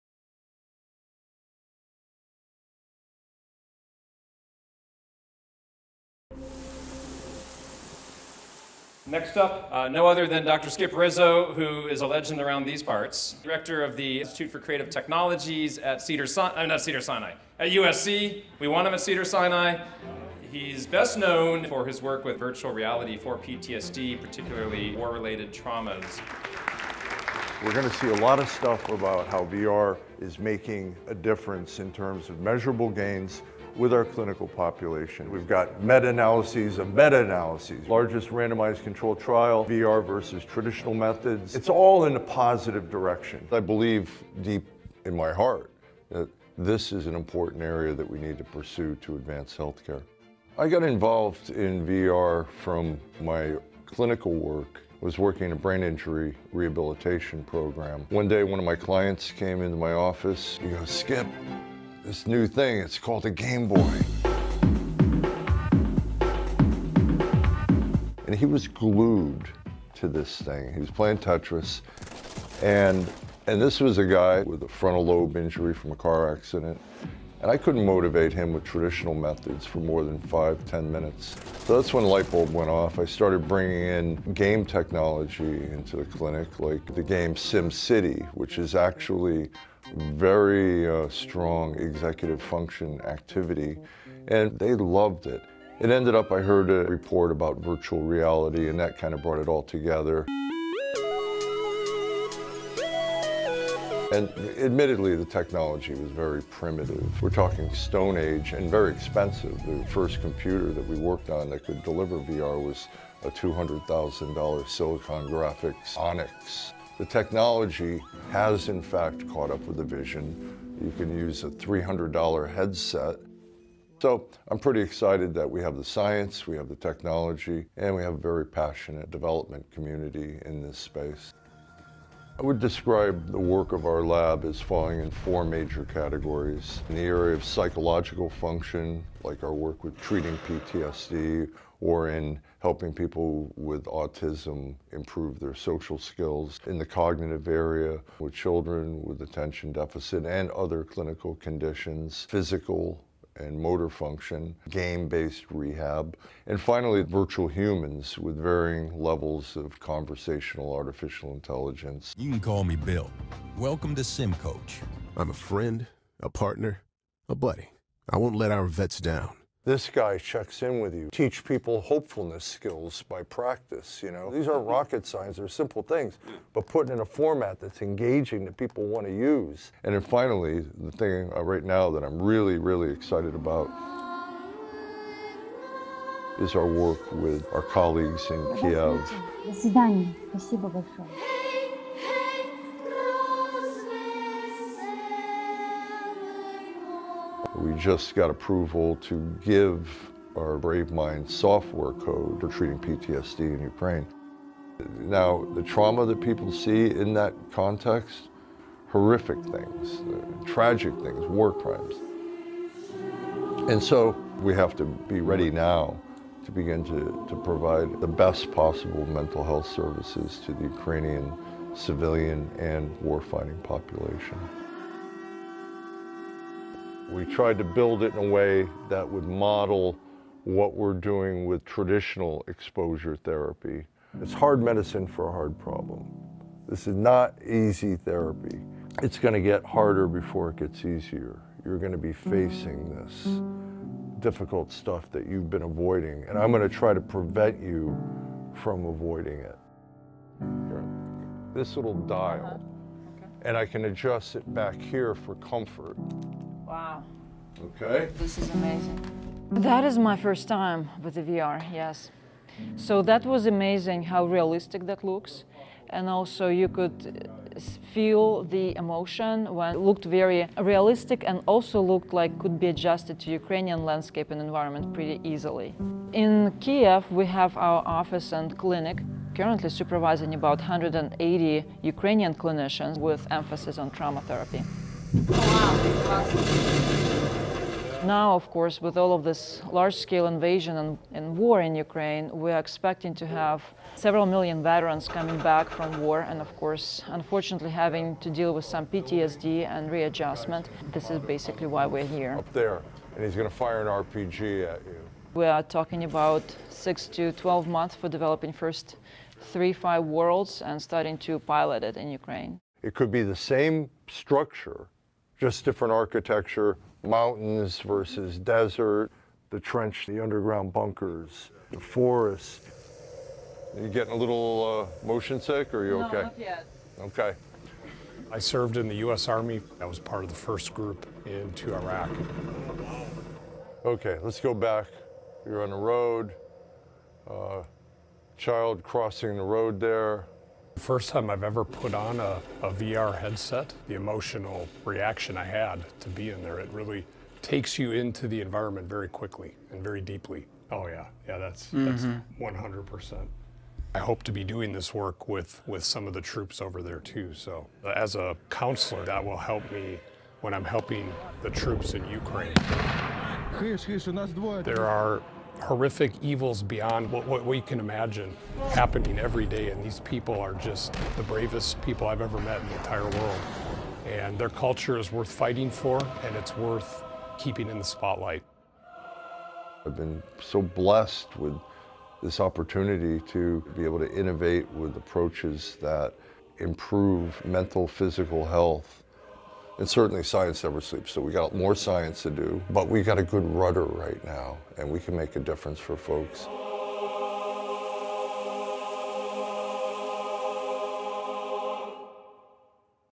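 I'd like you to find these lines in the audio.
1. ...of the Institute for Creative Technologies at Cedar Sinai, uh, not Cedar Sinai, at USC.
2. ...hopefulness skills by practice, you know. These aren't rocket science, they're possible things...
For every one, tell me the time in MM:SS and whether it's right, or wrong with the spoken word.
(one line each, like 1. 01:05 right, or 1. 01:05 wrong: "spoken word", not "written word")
1. 00:13 right
2. 02:51 wrong: "simple", not "possible".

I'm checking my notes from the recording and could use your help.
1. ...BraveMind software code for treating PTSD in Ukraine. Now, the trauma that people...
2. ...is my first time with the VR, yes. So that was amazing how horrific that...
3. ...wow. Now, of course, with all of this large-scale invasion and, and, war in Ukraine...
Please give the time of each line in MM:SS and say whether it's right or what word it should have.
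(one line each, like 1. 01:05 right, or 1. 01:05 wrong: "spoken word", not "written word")
1. 03:20 right
2. 04:19 wrong: "realistic", not "horrific"
3. 04:47 right.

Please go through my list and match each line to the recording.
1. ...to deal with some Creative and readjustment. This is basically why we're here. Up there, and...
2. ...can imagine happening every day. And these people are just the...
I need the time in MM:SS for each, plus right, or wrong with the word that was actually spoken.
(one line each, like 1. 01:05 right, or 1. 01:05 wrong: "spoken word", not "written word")
1. 04:58 wrong: "PTSD", not "Creative"
2. 06:07 right.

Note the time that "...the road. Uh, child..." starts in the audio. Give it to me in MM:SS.
05:35.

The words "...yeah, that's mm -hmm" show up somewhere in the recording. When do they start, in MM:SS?
05:51.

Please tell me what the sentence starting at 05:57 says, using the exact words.
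So as a counselor, that will help me when I'm helping the troops in Ukraine.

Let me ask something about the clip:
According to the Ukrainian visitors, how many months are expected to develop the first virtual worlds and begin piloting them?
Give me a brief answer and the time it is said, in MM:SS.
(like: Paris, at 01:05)
6 to 12 months, at 05:06.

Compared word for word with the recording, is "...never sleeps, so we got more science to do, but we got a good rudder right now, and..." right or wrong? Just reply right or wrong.
right.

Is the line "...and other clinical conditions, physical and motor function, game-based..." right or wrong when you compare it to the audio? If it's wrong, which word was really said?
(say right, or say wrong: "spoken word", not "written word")
right.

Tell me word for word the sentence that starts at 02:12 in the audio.
I would describe the work of our lab as falling in four major categories.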